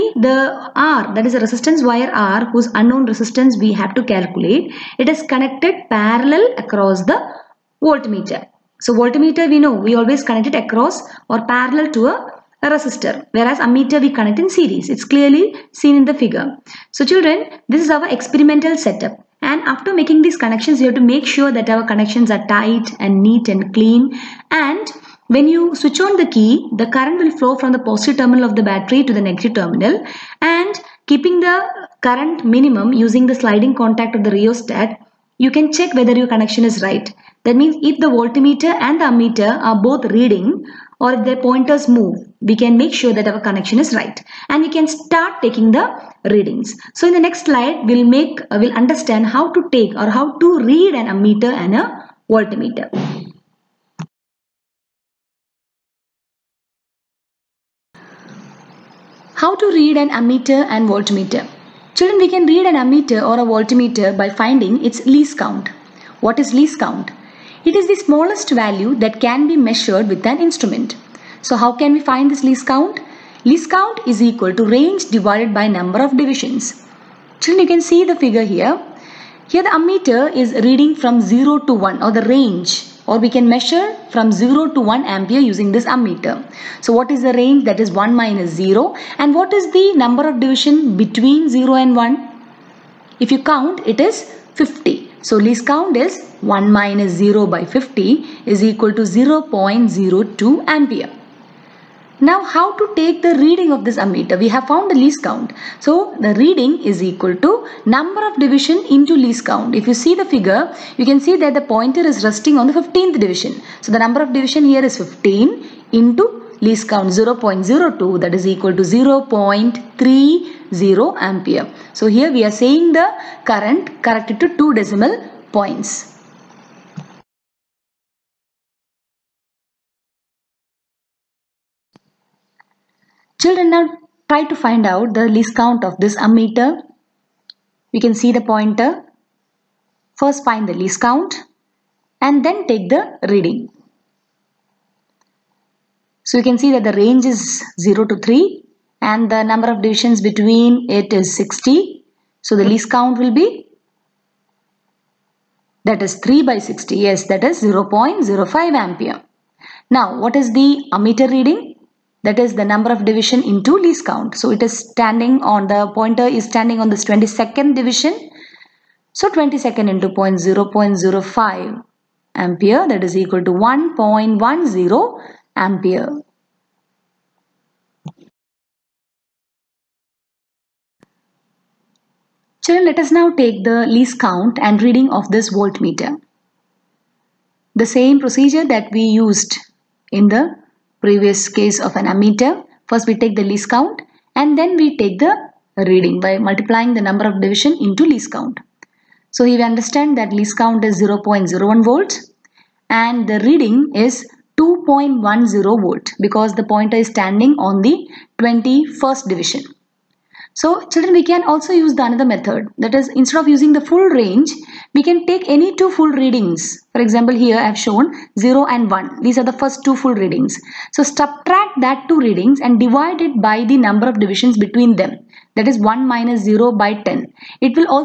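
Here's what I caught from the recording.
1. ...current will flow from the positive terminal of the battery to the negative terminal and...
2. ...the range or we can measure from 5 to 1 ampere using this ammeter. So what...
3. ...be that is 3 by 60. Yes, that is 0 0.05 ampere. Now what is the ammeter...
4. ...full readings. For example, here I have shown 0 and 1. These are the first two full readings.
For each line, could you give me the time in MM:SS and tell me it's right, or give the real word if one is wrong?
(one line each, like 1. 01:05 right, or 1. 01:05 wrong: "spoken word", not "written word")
1. 00:26 right
2. 01:22 wrong: "0", not "5"
3. 02:33 right
4. 03:35 right.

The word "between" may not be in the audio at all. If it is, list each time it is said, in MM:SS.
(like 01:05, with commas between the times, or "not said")
01:30, 02:30, 03:44.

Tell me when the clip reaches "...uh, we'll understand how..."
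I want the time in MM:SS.
00:48.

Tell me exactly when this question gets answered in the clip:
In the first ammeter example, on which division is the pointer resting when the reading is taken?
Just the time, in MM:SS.
01:52.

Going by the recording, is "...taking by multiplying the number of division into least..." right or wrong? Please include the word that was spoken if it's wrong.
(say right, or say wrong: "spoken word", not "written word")
wrong: "reading", not "taking".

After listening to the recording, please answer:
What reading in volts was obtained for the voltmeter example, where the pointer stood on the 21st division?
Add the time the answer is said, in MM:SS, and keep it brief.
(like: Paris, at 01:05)
2.10 volt, at 03:24.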